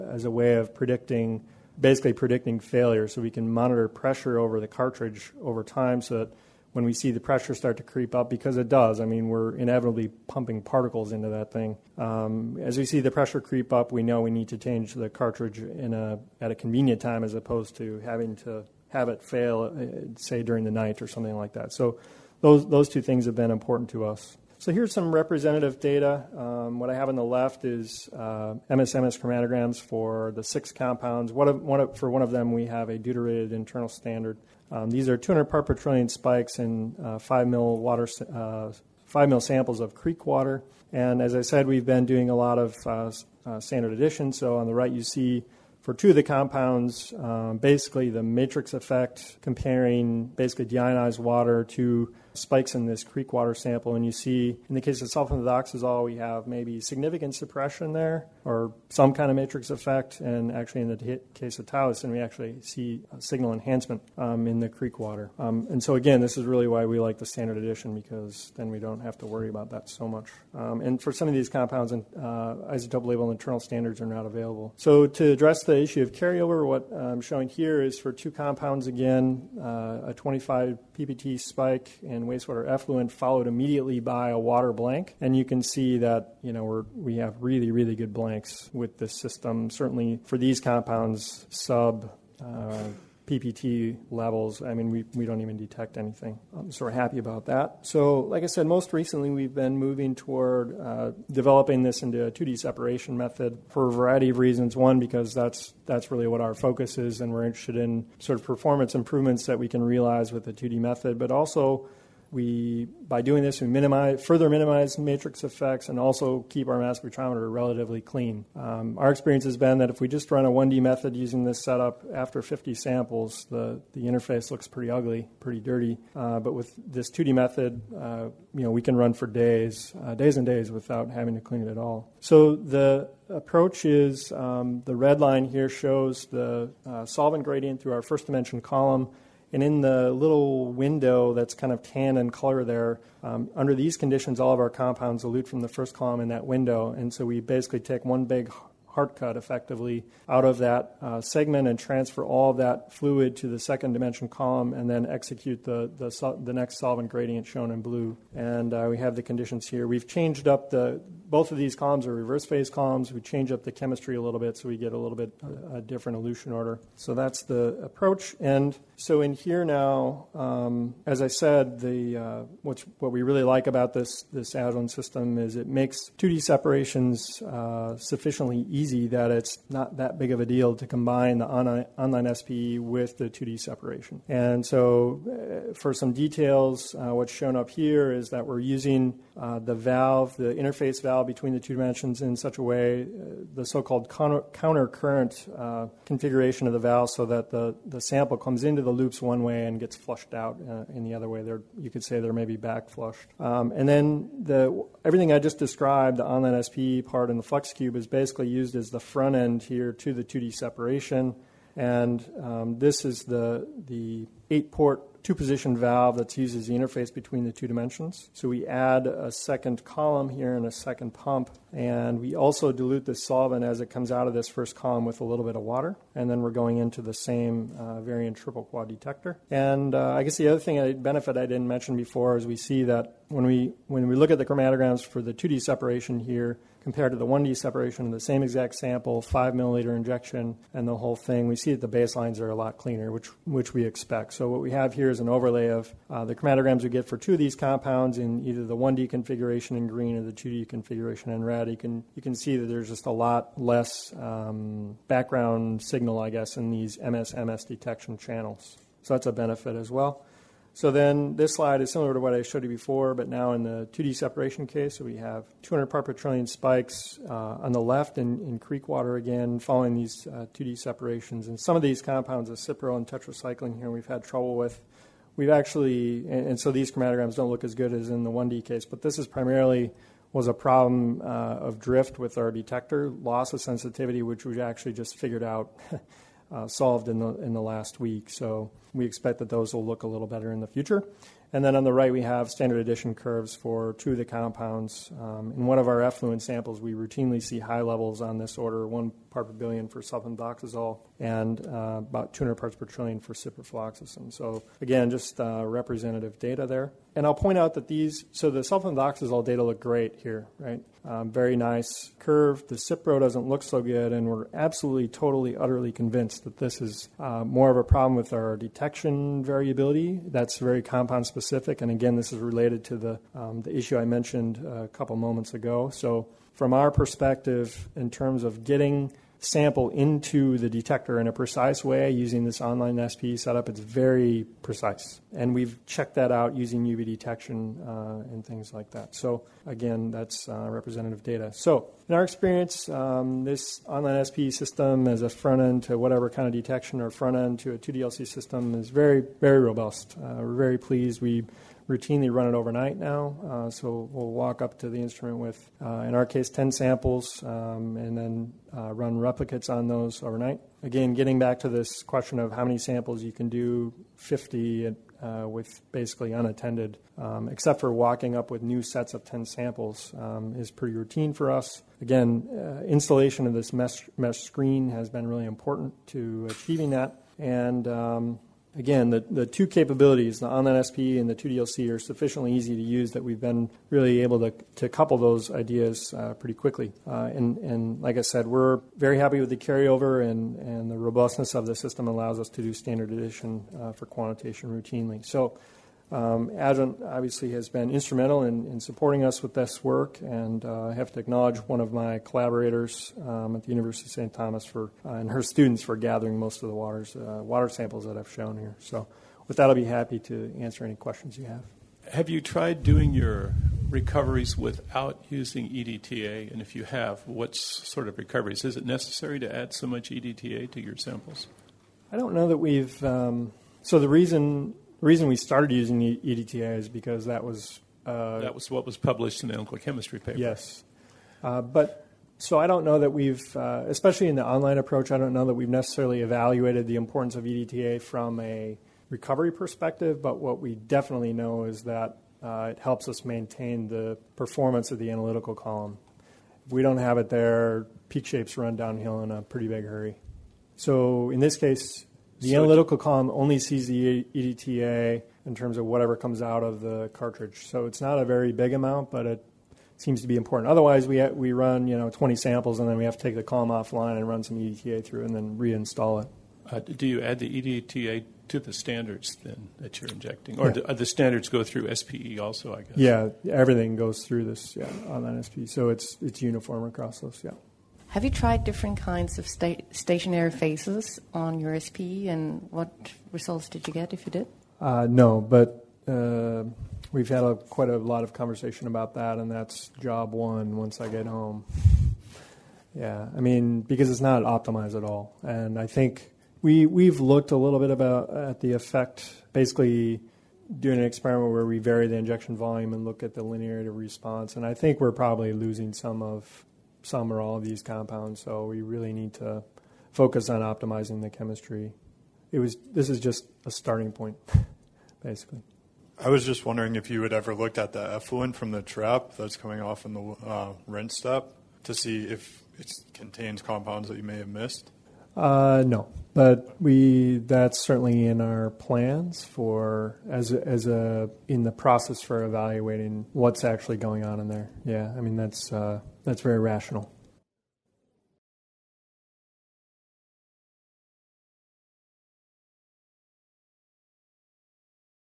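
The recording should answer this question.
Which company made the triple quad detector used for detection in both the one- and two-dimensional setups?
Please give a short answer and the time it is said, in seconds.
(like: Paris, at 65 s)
Varian, at 228 s.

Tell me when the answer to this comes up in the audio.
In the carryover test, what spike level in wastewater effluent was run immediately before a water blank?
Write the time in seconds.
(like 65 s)
80 s.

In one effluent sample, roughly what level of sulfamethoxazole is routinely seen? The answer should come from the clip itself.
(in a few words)
1 ppb.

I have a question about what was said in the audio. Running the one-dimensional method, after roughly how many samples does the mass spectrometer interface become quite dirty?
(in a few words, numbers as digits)
50.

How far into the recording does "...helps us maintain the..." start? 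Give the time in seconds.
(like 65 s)
442 s.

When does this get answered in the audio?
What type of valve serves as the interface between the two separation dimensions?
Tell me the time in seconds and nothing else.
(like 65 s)
214 s.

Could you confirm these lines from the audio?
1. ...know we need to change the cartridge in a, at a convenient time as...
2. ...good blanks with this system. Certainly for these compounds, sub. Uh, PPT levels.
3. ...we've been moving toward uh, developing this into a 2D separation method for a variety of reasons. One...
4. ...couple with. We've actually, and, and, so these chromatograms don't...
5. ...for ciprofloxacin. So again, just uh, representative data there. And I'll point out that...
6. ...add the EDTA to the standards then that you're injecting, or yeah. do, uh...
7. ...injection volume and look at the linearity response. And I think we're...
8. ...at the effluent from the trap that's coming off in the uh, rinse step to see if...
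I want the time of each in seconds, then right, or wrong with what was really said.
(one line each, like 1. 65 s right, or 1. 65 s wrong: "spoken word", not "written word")
1. 14 s right
2. 87 s right
3. 99 s right
4. 274 s wrong: "trouble", not "couple"
5. 303 s right
6. 467 s right
7. 502 s right
8. 517 s right.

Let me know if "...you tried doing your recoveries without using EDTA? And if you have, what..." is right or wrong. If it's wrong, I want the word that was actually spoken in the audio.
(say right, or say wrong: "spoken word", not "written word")
right.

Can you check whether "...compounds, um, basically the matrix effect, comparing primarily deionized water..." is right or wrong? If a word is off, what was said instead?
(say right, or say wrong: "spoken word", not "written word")
wrong: "basically", not "primarily".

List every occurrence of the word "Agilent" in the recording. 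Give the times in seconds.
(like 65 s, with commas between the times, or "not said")
174 s, 396 s.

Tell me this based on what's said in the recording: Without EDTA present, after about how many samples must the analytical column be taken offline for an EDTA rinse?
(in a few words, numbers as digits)
20.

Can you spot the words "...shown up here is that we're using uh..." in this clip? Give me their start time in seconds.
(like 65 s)
187 s.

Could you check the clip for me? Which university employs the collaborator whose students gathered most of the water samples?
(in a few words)
University of St. Thomas.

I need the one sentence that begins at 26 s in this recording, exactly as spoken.
Um, what I have on the left is uh, MSMS chromatograms for the six compounds.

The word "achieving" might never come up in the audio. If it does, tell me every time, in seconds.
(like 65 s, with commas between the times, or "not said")
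376 s.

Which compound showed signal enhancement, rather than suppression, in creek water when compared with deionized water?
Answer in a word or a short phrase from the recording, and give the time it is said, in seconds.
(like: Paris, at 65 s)
Towson, at 61 s.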